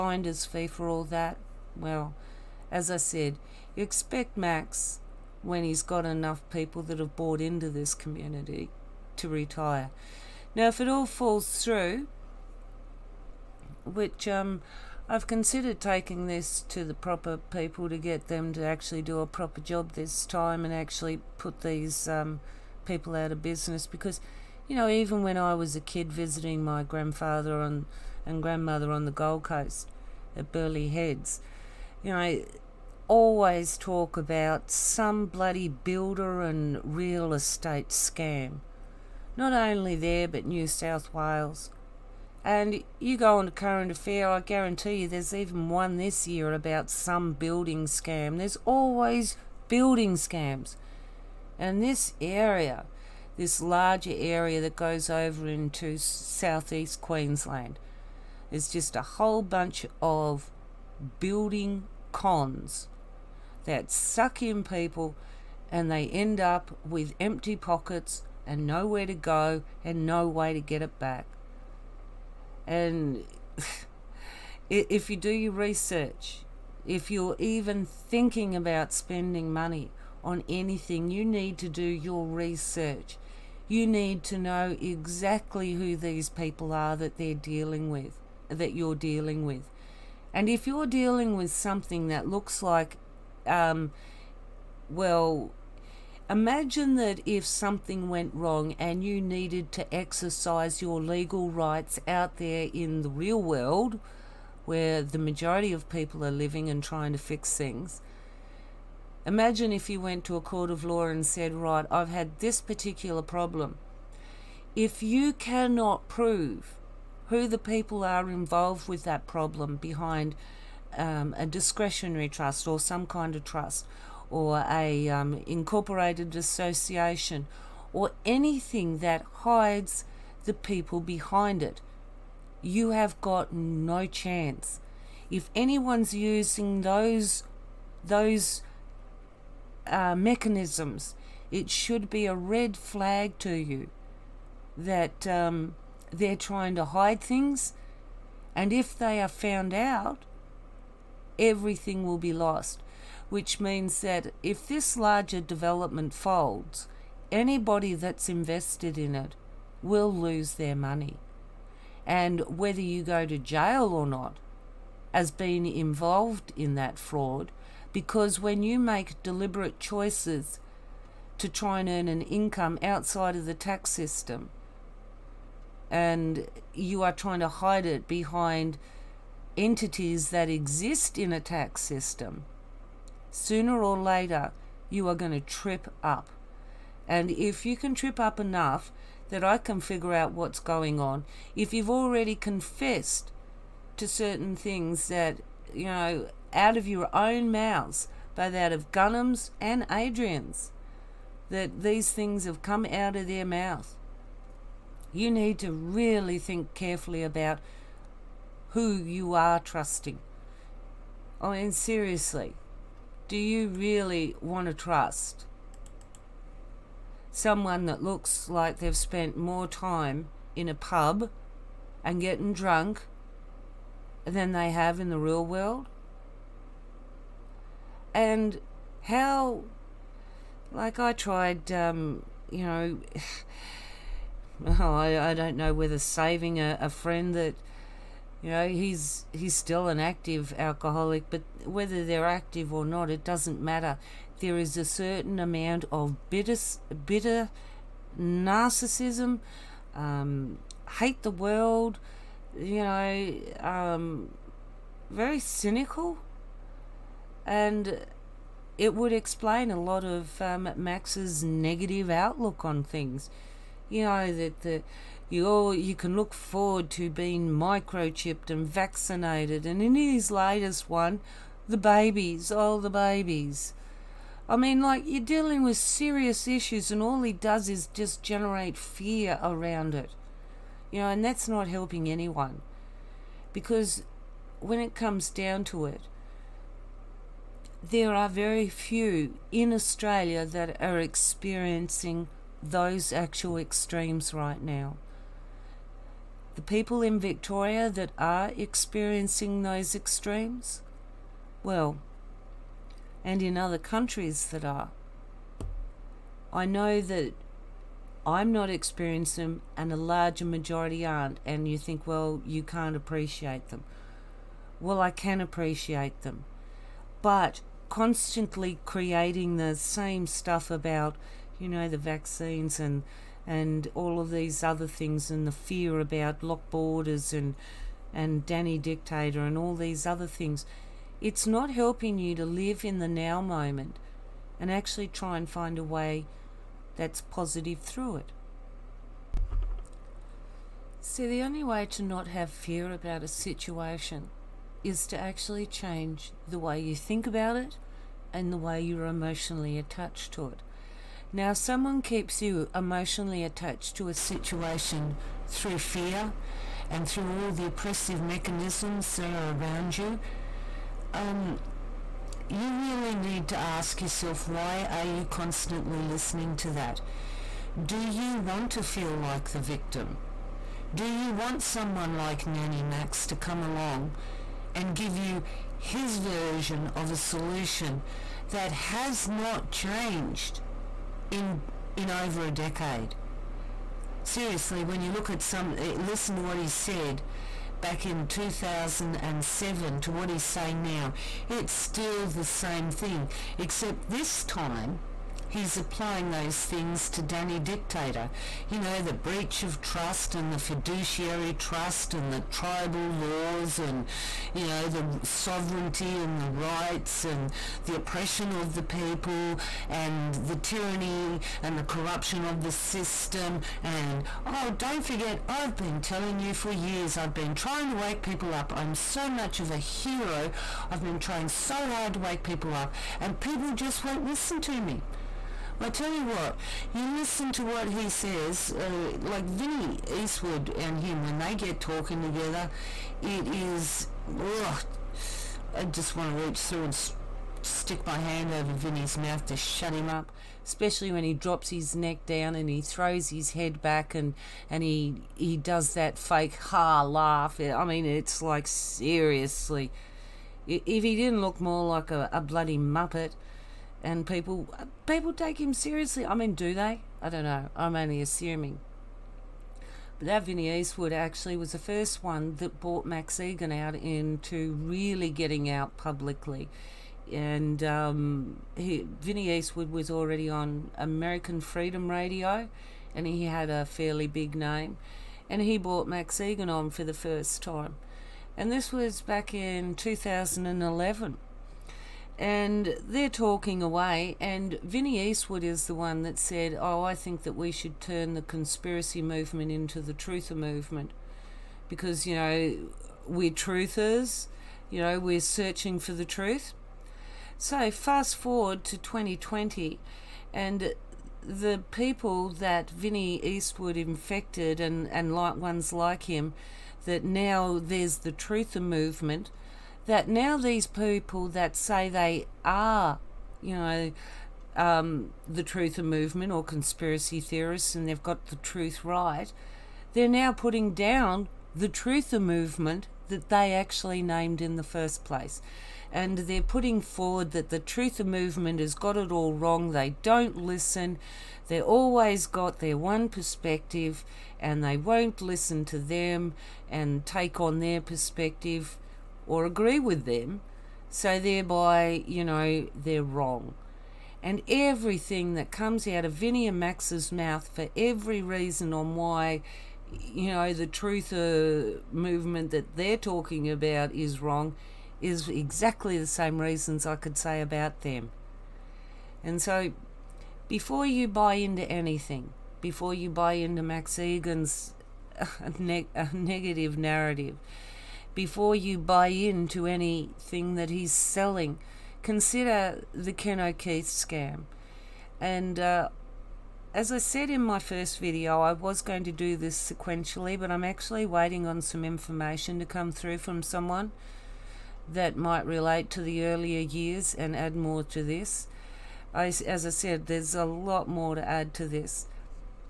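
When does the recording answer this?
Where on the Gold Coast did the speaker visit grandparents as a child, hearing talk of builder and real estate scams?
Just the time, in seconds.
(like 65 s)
30 s.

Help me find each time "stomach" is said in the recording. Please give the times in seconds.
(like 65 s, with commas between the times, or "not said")
not said.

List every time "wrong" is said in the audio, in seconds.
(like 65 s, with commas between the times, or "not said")
98 s, 529 s, 543 s, 554 s.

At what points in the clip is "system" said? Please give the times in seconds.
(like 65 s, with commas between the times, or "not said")
173 s, 181 s, 412 s.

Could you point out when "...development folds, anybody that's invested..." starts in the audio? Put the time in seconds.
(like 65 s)
155 s.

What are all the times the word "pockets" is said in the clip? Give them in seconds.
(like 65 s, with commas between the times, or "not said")
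67 s.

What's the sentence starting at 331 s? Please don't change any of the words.
It's not helping you to live in the now moment and actually try and find a way that's positive through it.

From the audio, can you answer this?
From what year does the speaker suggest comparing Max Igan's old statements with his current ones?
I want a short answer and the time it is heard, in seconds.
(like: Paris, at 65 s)
2007, at 388 s.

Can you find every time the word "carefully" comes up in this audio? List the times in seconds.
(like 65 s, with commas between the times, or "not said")
206 s.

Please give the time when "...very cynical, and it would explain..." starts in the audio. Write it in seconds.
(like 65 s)
255 s.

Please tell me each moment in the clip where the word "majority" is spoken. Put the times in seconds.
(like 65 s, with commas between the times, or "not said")
105 s, 310 s.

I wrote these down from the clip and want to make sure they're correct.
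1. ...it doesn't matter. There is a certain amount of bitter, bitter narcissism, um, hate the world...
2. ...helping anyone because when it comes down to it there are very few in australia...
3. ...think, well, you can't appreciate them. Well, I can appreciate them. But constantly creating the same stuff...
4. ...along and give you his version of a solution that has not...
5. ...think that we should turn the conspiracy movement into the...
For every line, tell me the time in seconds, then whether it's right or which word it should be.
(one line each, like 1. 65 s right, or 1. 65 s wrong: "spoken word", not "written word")
1. 243 s right
2. 281 s right
3. 311 s right
4. 373 s right
5. 487 s right.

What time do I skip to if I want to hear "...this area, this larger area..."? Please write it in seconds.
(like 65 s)
51 s.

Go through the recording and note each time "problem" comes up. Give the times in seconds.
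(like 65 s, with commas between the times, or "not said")
113 s, 119 s.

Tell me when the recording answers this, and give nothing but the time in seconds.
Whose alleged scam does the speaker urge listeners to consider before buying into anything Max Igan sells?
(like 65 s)
573 s.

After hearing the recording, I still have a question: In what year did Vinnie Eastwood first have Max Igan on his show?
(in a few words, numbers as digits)
2011.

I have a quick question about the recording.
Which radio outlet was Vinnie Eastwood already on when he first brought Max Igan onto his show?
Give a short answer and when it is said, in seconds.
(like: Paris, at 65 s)
American Freedom Radio, at 470 s.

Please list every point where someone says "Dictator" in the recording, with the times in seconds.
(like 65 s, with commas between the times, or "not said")
328 s, 397 s.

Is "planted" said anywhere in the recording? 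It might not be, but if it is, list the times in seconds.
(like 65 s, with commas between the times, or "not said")
not said.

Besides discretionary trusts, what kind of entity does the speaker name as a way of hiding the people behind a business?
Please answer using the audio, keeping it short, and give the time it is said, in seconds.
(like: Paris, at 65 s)
incorporated association, at 125 s.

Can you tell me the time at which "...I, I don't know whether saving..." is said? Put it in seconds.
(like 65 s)
234 s.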